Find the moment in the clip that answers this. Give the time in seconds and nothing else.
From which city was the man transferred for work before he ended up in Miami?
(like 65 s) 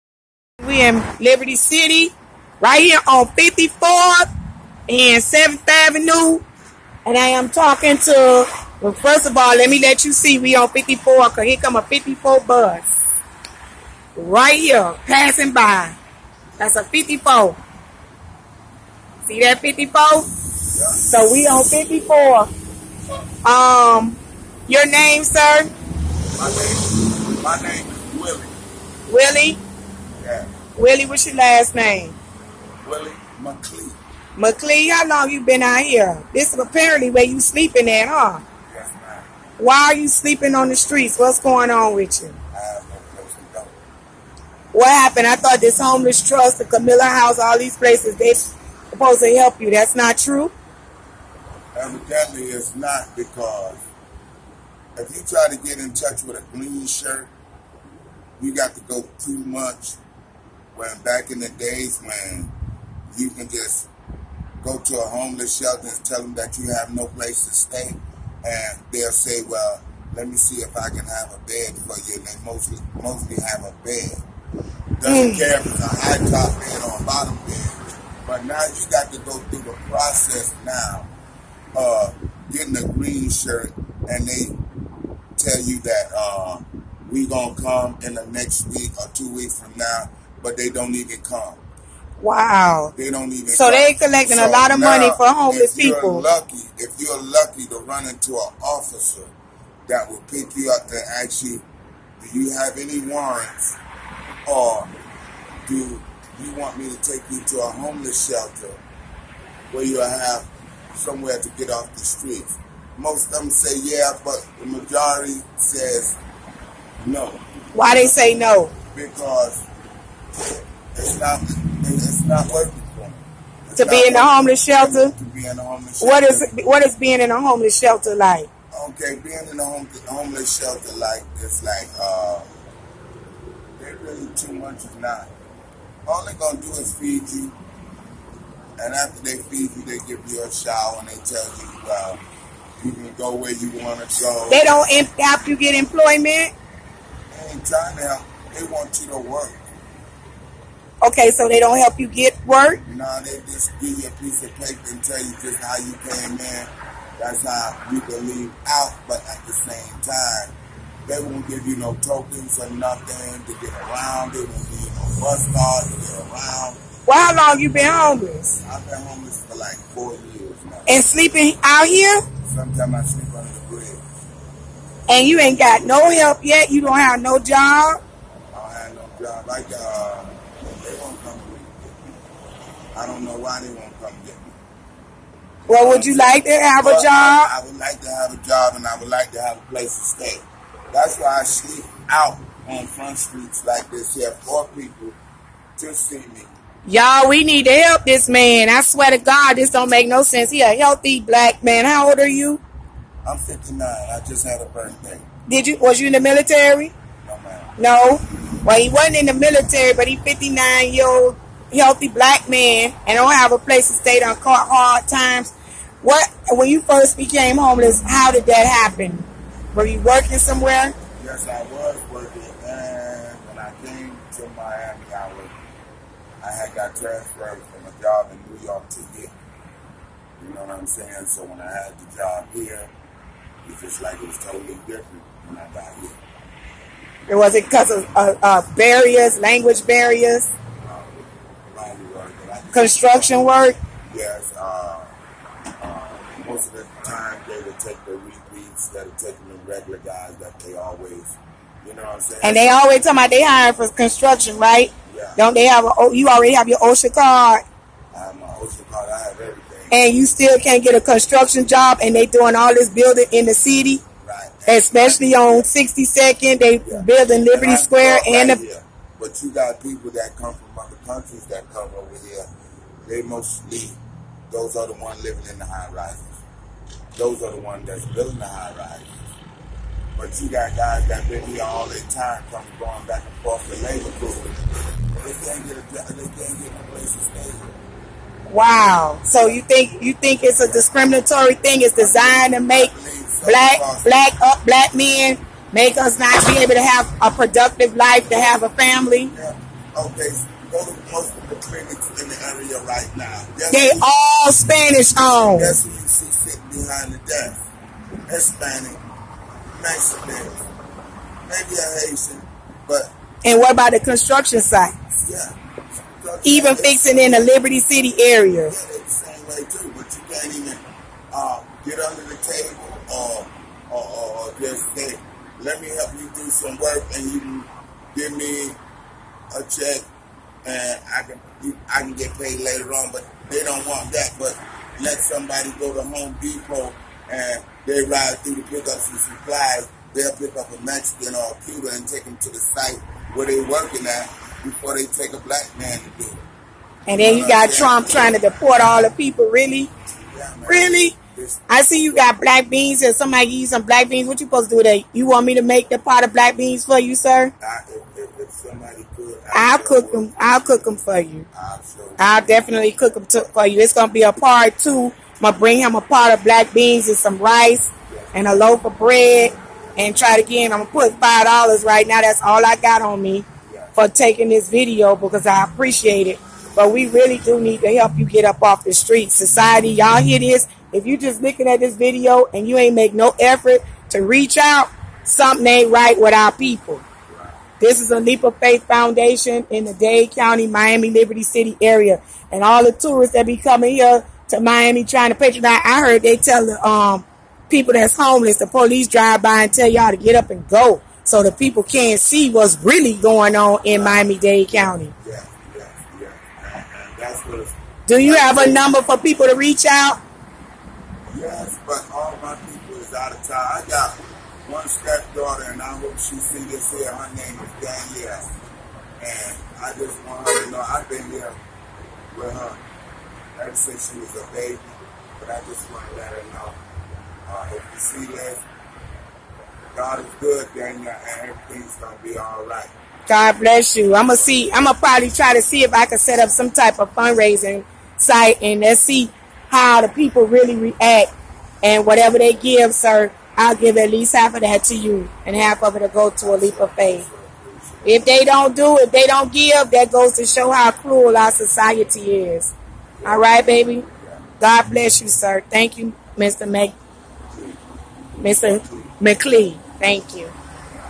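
228 s.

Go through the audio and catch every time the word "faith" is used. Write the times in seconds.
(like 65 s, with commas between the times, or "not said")
388 s, 446 s.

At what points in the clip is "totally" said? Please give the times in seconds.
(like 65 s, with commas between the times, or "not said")
234 s.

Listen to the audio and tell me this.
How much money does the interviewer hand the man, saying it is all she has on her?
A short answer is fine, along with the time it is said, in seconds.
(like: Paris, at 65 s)
$5, at 371 s.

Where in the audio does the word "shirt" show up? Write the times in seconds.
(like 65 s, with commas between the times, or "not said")
56 s, 83 s.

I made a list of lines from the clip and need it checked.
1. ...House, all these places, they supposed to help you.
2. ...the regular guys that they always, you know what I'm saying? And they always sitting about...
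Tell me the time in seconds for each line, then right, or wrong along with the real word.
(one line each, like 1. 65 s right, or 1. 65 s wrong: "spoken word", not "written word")
1. 47 s right
2. 249 s wrong: "talking", not "sitting".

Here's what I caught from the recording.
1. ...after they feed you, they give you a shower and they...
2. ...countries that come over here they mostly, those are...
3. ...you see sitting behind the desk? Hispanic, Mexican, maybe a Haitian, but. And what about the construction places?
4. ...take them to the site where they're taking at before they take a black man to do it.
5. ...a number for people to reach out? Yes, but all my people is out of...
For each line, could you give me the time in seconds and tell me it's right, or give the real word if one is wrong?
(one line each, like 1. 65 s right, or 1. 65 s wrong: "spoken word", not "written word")
1. 138 s right
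2. 271 s right
3. 305 s wrong: "sites", not "places"
4. 342 s wrong: "working", not "taking"
5. 408 s right.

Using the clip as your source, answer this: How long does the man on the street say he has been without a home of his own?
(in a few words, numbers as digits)
4 years.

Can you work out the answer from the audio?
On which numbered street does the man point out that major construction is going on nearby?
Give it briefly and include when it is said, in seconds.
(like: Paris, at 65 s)
62nd, at 265 s.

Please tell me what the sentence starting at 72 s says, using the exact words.
And they mostly, mostly have a bed.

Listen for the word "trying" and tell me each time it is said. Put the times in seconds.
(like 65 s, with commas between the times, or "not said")
147 s, 348 s, 395 s.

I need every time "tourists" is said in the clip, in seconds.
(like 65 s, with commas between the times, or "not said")
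392 s.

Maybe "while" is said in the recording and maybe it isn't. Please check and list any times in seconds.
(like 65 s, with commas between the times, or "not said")
not said.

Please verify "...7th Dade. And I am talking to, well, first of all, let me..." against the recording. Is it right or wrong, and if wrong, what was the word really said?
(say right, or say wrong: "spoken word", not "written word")
wrong: "Avenue", not "Dade".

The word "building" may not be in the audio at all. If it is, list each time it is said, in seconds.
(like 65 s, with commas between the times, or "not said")
262 s, 267 s, 278 s.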